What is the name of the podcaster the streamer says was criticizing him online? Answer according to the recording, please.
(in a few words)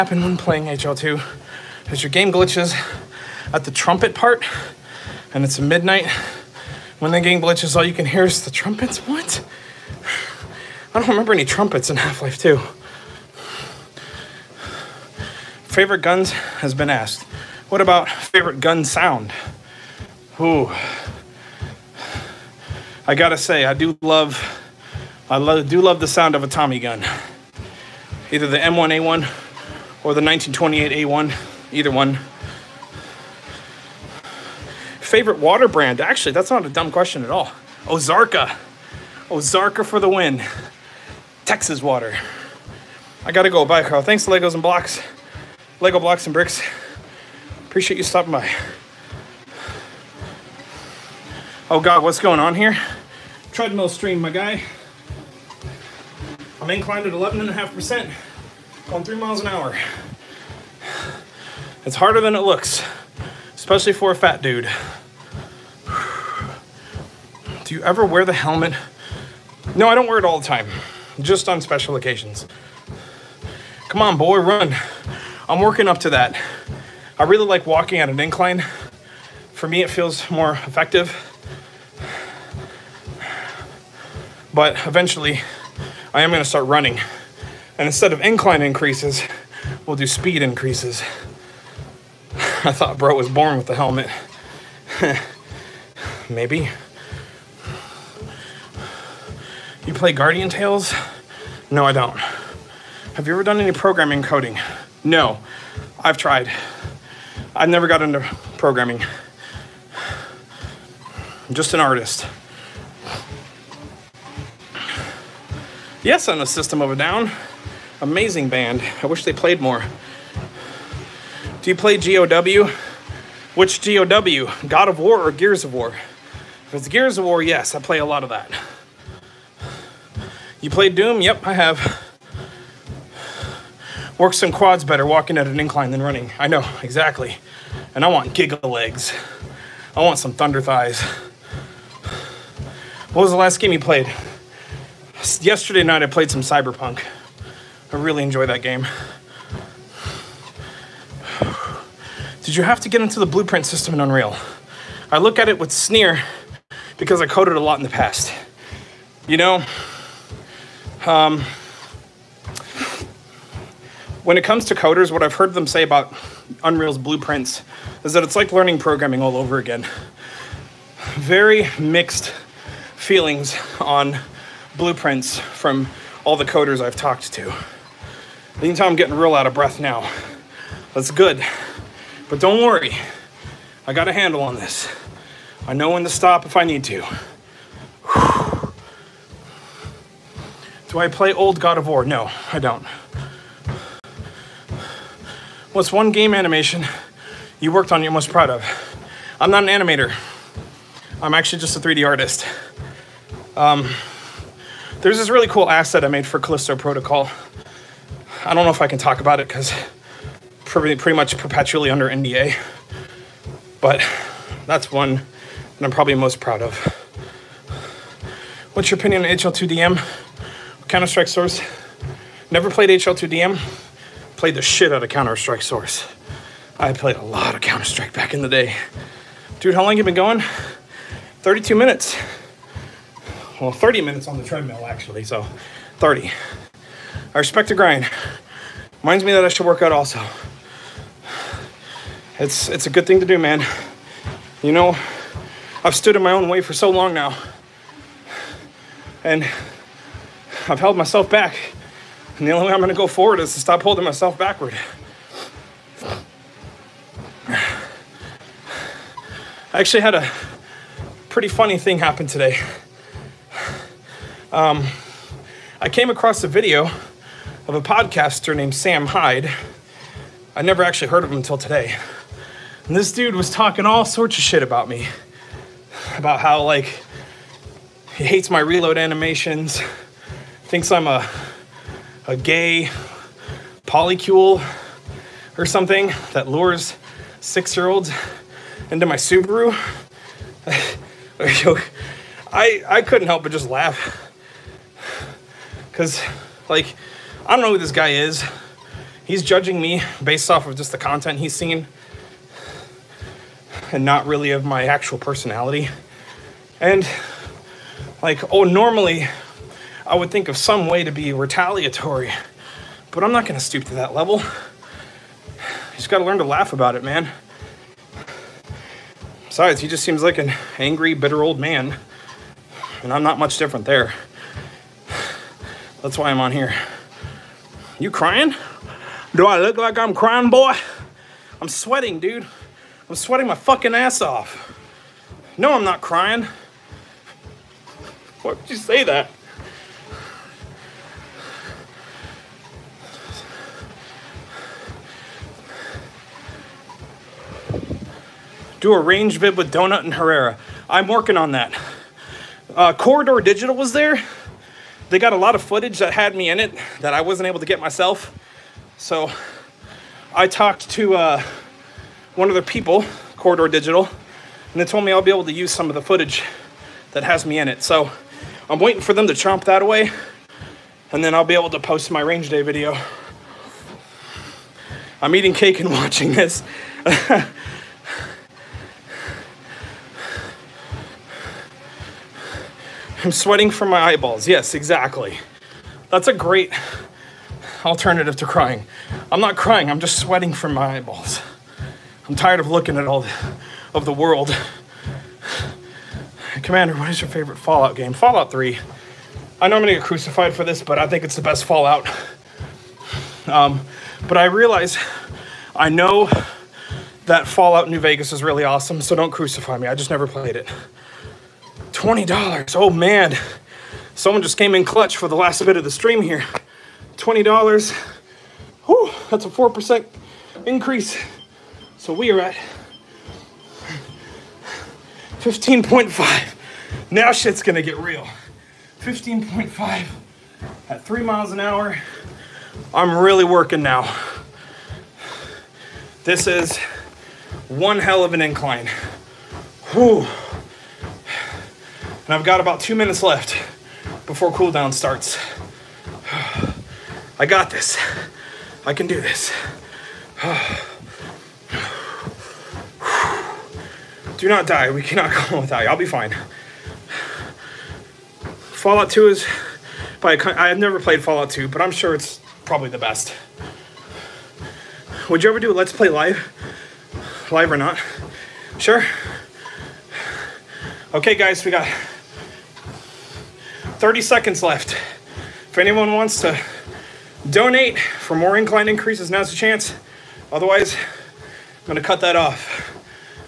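Sam Hyde.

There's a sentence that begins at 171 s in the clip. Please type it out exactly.
Very mixed feelings on blueprints from all the coders I've talked to.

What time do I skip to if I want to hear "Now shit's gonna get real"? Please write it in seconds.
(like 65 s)
427 s.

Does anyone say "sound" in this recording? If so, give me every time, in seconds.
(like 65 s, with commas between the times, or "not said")
18 s, 26 s.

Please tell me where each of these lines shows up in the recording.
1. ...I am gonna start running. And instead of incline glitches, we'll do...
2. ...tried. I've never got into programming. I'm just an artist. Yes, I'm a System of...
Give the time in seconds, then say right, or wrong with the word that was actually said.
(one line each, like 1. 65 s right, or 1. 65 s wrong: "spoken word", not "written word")
1. 86 s wrong: "increases", not "glitches"
2. 106 s right.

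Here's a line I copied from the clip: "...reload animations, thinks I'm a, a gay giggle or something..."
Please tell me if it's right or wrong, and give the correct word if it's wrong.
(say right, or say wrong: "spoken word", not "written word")
wrong: "polycule", not "giggle".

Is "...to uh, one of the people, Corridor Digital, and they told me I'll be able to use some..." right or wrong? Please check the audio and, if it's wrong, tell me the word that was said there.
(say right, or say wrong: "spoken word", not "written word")
right.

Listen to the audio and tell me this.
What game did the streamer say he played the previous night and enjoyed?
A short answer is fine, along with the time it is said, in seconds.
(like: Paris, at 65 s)
Cyberpunk, at 146 s.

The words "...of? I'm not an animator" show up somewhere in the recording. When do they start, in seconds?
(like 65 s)
198 s.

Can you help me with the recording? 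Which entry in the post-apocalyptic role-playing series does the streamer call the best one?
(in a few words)
Fallout 3.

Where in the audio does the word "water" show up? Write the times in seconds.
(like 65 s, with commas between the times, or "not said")
35 s, 41 s.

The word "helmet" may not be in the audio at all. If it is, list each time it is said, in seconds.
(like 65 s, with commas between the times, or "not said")
68 s, 93 s.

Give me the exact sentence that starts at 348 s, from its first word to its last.
do a range bid with Donut and Herrera.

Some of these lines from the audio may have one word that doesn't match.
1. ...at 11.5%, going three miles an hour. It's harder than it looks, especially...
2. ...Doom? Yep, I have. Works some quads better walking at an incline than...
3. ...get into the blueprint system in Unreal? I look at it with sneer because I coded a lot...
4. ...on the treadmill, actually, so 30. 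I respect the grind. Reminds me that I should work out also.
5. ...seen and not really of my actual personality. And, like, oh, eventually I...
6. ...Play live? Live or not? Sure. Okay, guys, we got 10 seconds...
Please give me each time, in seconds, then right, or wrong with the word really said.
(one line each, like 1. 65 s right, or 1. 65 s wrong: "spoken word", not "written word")
1. 57 s right
2. 130 s right
3. 152 s right
4. 234 s right
5. 301 s wrong: "normally", not "eventually"
6. 465 s wrong: "30", not "10".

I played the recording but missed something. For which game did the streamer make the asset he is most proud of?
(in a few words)
Callisto Protocol.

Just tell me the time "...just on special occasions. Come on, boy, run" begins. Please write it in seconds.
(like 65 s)
71 s.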